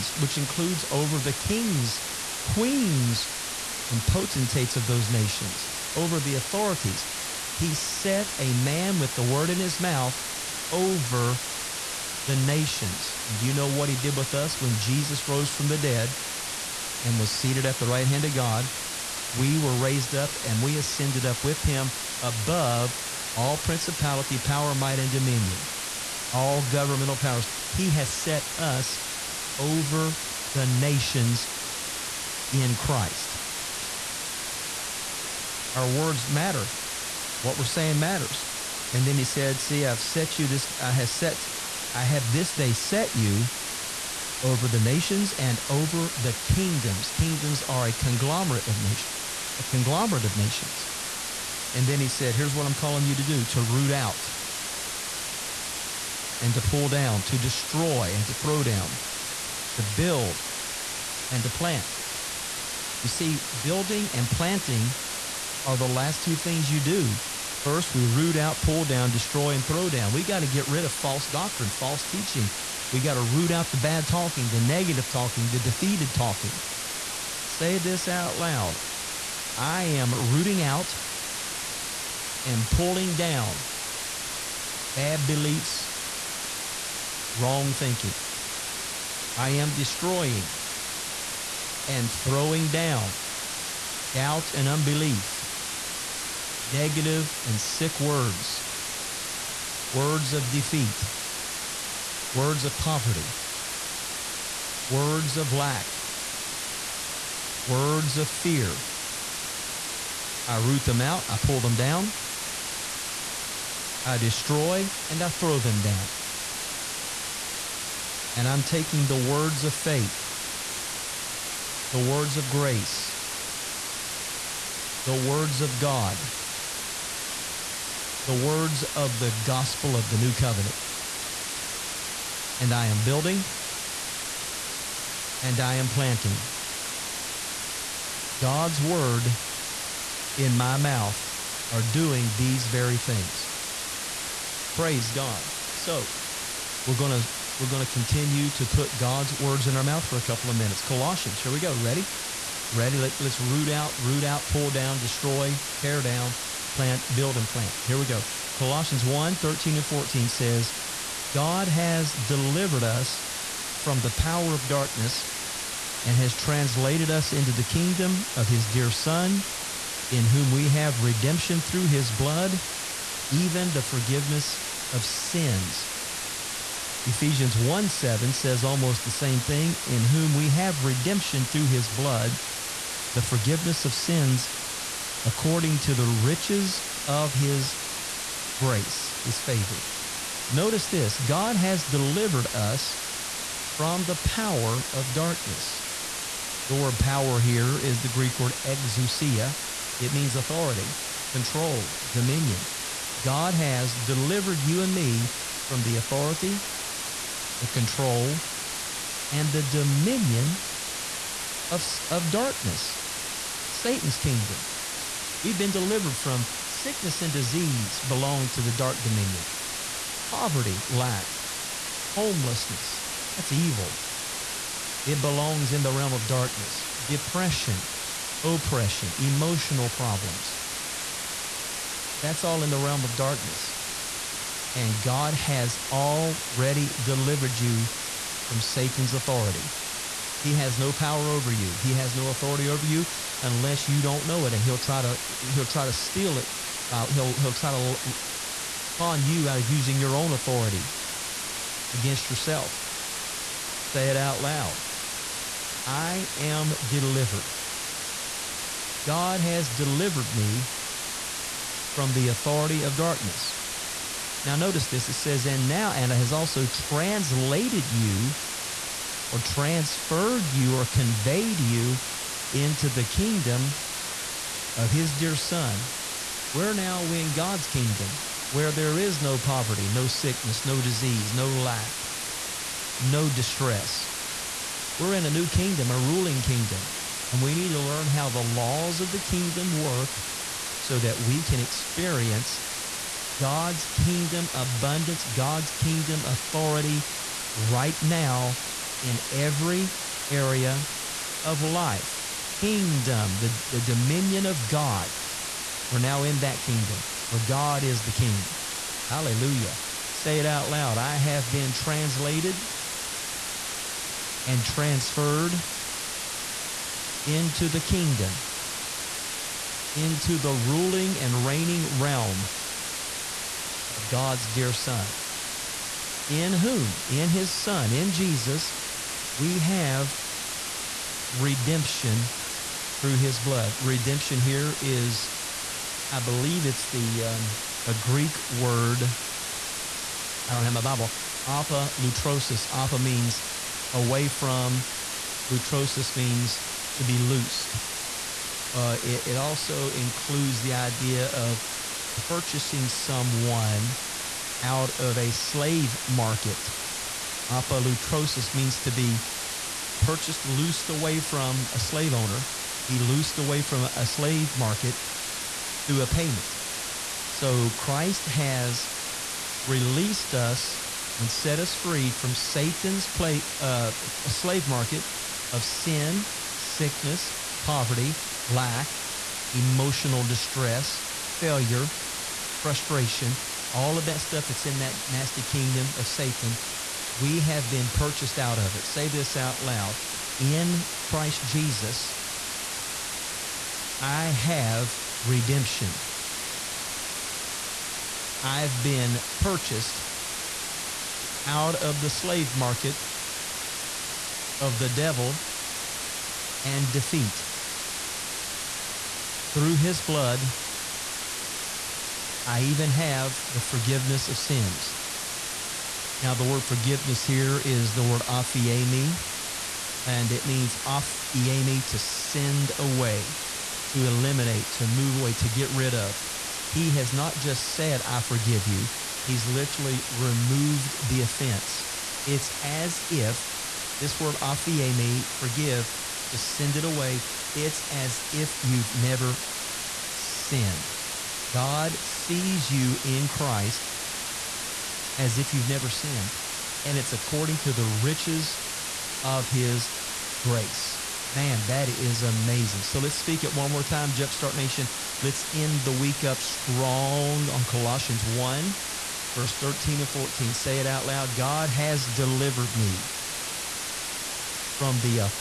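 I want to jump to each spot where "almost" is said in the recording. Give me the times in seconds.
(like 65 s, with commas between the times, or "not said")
178 s.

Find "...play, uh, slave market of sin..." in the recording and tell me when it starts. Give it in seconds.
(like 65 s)
373 s.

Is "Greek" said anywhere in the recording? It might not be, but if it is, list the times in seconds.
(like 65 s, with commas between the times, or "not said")
198 s, 337 s.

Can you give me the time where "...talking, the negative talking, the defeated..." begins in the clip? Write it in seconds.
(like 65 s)
74 s.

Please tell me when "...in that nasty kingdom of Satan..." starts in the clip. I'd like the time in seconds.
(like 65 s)
384 s.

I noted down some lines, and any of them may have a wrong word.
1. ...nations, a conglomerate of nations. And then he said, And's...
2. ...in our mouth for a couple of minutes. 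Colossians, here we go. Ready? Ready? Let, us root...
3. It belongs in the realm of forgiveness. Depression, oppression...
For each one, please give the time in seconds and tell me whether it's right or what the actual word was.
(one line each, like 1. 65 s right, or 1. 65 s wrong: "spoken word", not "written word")
1. 48 s wrong: "Here", not "And"
2. 149 s right
3. 225 s wrong: "darkness", not "forgiveness".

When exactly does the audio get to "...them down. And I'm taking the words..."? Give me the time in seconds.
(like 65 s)
115 s.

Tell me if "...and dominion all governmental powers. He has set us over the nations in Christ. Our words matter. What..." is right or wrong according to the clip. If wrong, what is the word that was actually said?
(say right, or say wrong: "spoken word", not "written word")
right.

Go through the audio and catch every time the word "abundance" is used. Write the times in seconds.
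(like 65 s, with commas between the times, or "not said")
294 s.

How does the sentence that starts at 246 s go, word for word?
He'll he'll try to con you out of using your own authority against yourself.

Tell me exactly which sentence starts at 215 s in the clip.
We've been delivered from sickness and disease belong to the dark dominion.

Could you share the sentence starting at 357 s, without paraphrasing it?
Apolutrosis means to be purchased, loosed away from a slave owner, be loosed away from a slave market through a payment.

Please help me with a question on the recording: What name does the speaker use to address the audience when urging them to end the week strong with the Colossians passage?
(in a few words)
Jumpstart Nation.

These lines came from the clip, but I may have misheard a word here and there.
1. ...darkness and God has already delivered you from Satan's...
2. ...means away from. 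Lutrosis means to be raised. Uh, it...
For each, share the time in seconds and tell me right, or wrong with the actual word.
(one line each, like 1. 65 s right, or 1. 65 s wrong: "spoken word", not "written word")
1. 233 s right
2. 342 s wrong: "loosed", not "raised".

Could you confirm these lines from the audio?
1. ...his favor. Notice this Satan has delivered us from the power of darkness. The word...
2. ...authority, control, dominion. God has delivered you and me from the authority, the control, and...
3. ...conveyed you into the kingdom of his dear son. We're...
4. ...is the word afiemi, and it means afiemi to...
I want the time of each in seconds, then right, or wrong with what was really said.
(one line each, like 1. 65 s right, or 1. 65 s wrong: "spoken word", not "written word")
1. 189 s wrong: "God", not "Satan"
2. 200 s right
3. 270 s right
4. 417 s right.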